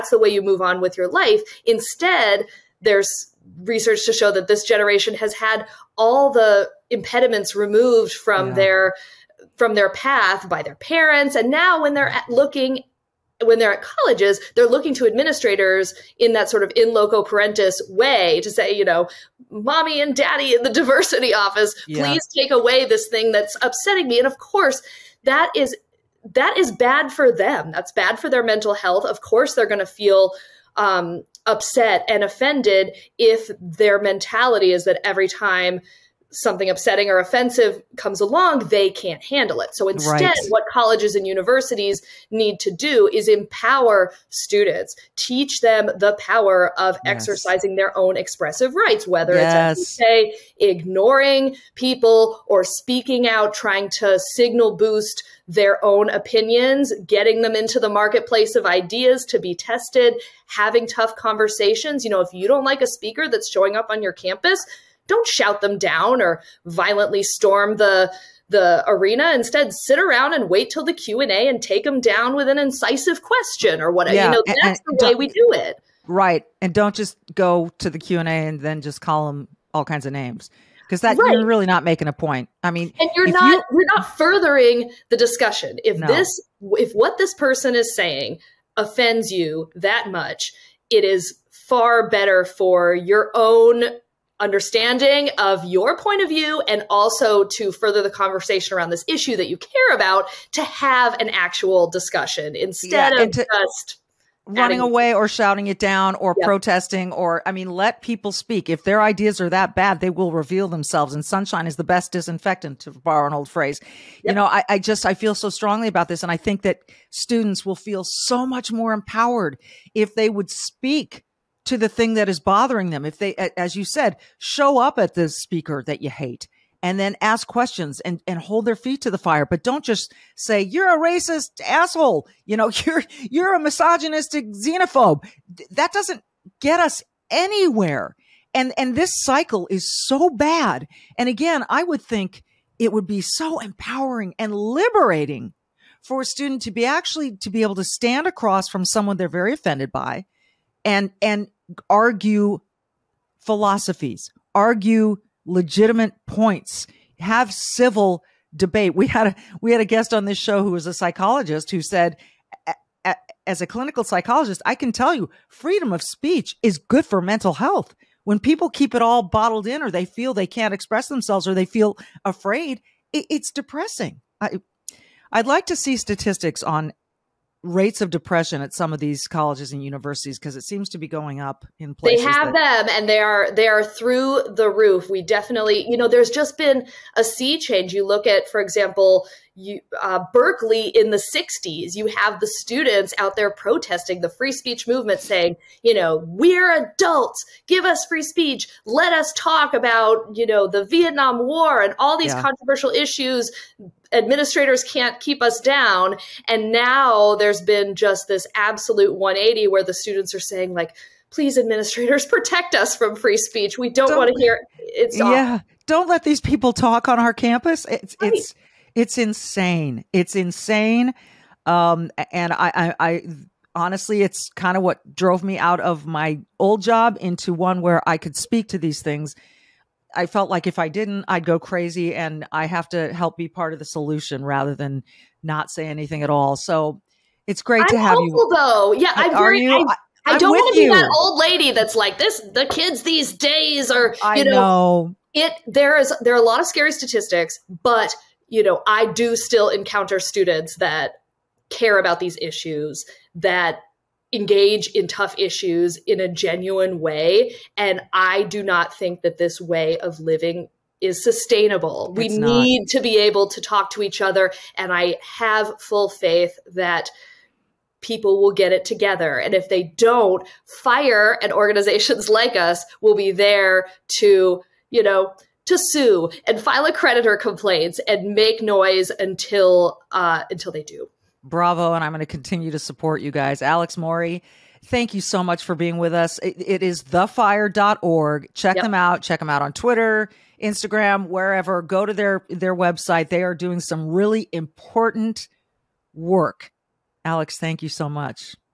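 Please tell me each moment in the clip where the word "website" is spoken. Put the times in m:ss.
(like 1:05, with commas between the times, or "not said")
4:52.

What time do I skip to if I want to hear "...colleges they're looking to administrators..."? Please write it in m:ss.
0:13.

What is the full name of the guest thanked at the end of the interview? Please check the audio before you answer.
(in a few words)
Alex Morey.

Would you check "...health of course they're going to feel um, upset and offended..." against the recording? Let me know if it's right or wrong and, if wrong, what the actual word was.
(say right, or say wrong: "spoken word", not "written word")
right.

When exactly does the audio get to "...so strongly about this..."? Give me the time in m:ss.
1:55.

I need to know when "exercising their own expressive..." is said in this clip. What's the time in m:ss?
0:47.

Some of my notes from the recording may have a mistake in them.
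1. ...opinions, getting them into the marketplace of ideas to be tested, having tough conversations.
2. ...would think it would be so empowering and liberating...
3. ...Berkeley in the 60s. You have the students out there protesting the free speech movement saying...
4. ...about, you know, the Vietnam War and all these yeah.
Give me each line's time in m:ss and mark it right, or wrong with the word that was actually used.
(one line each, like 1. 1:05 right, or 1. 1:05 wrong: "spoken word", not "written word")
1. 0:56 right
2. 2:21 right
3. 3:10 right
4. 3:19 right.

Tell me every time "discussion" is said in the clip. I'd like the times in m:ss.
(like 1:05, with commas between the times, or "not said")
1:25, 1:41.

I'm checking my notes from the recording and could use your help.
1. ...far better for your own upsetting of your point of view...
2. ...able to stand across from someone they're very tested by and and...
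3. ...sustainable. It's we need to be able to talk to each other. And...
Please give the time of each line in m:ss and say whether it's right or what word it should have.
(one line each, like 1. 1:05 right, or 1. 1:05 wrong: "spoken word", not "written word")
1. 1:31 wrong: "understanding", not "upsetting"
2. 2:27 wrong: "offended", not "tested"
3. 4:21 right.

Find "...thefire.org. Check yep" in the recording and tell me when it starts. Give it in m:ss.
4:47.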